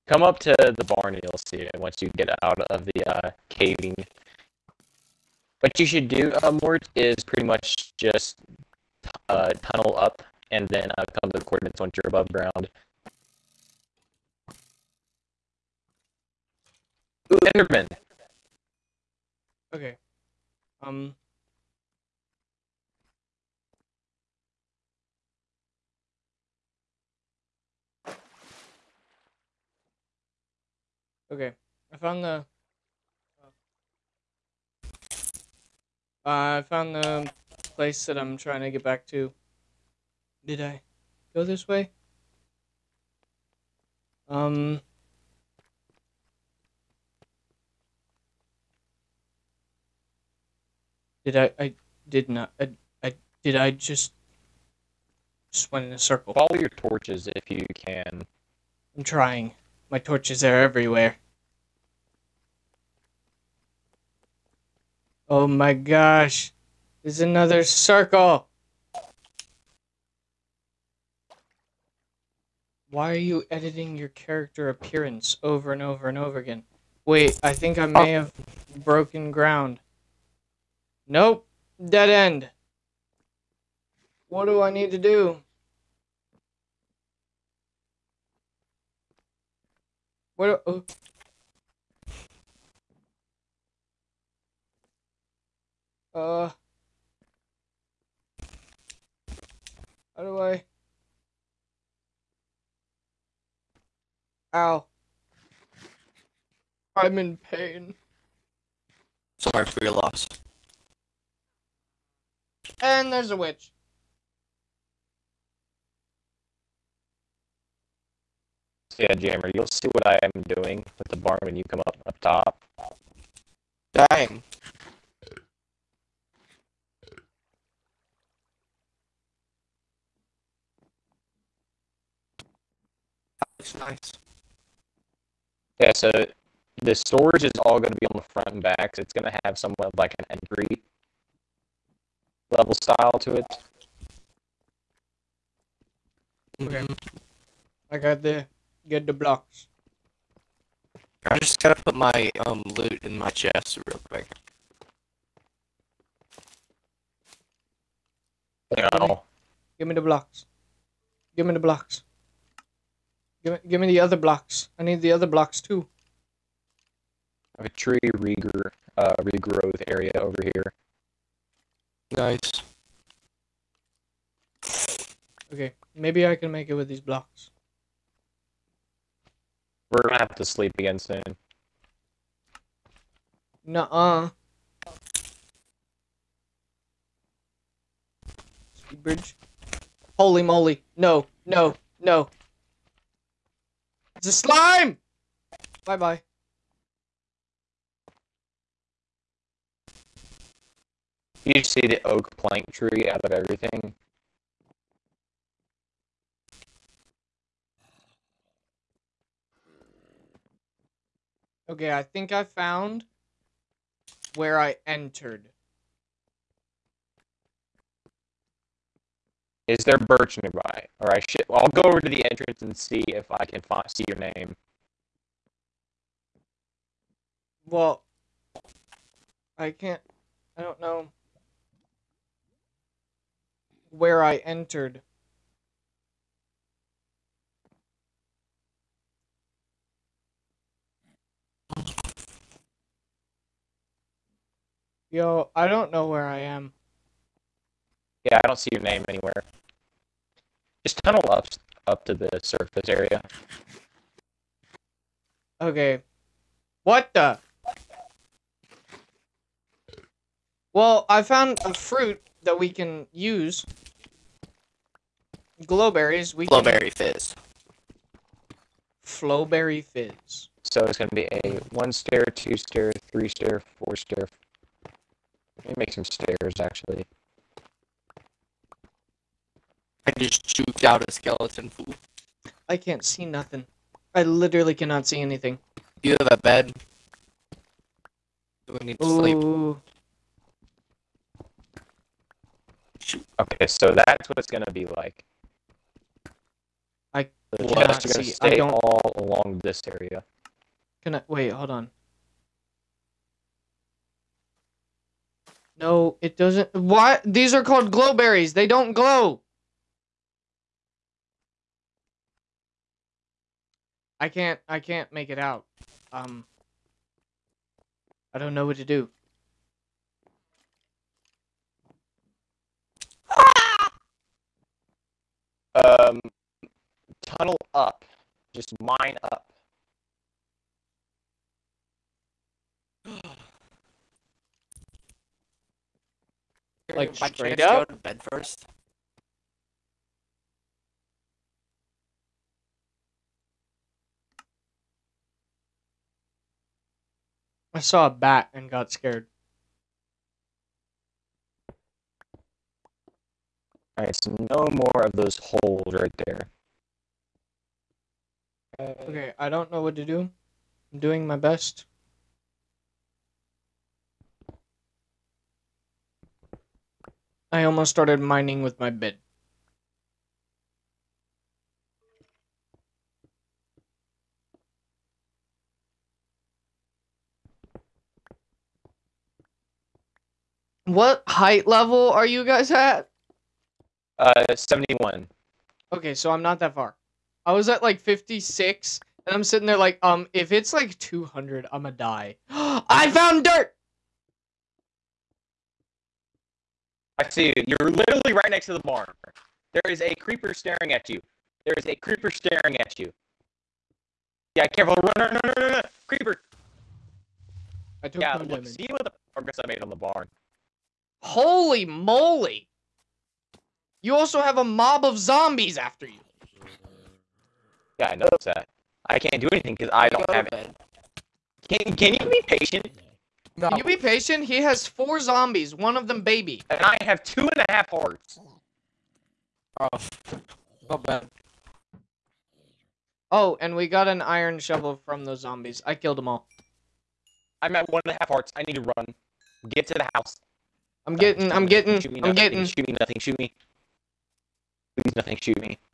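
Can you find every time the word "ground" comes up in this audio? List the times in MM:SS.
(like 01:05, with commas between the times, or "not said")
00:12, 01:19.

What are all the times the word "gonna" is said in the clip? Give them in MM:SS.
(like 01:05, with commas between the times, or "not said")
03:00, 04:54, 06:31.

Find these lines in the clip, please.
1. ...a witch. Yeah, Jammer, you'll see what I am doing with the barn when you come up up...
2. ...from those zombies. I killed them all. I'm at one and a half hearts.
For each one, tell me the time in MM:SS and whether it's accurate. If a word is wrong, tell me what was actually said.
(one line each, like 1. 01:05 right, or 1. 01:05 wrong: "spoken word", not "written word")
1. 01:53 right
2. 07:15 right.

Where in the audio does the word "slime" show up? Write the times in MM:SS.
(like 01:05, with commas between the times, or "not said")
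03:14.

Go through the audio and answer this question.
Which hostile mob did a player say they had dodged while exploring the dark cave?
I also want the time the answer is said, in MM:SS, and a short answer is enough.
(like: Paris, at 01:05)
skeleton, at 04:41.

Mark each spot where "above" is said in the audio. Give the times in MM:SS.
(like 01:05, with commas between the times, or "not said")
00:12.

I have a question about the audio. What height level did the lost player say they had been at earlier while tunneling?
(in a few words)
56.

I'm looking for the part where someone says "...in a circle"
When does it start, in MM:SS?
00:55.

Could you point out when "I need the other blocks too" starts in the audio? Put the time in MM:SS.
02:44.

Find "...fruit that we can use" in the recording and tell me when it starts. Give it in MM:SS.
04:21.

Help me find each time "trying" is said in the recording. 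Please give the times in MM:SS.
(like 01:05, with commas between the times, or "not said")
00:38, 00:59.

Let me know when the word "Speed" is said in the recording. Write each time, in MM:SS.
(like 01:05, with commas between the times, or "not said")
03:08.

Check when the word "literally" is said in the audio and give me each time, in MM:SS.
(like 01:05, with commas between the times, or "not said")
04:44, 06:37.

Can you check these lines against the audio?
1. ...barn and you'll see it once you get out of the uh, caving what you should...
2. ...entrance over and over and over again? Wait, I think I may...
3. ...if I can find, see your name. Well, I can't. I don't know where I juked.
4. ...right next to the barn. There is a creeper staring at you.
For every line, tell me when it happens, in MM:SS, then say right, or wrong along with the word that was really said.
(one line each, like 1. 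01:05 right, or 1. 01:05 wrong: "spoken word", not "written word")
1. 00:00 right
2. 01:14 wrong: "appearance", not "entrance"
3. 03:43 wrong: "entered", not "juked"
4. 06:38 right.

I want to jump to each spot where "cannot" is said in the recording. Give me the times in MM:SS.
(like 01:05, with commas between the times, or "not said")
04:44, 04:57.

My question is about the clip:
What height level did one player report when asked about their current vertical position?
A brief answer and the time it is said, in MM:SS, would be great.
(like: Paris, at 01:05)
71, at 06:24.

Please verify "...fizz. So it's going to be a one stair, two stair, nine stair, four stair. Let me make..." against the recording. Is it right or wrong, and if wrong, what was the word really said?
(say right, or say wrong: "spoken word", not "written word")
wrong: "three", not "nine".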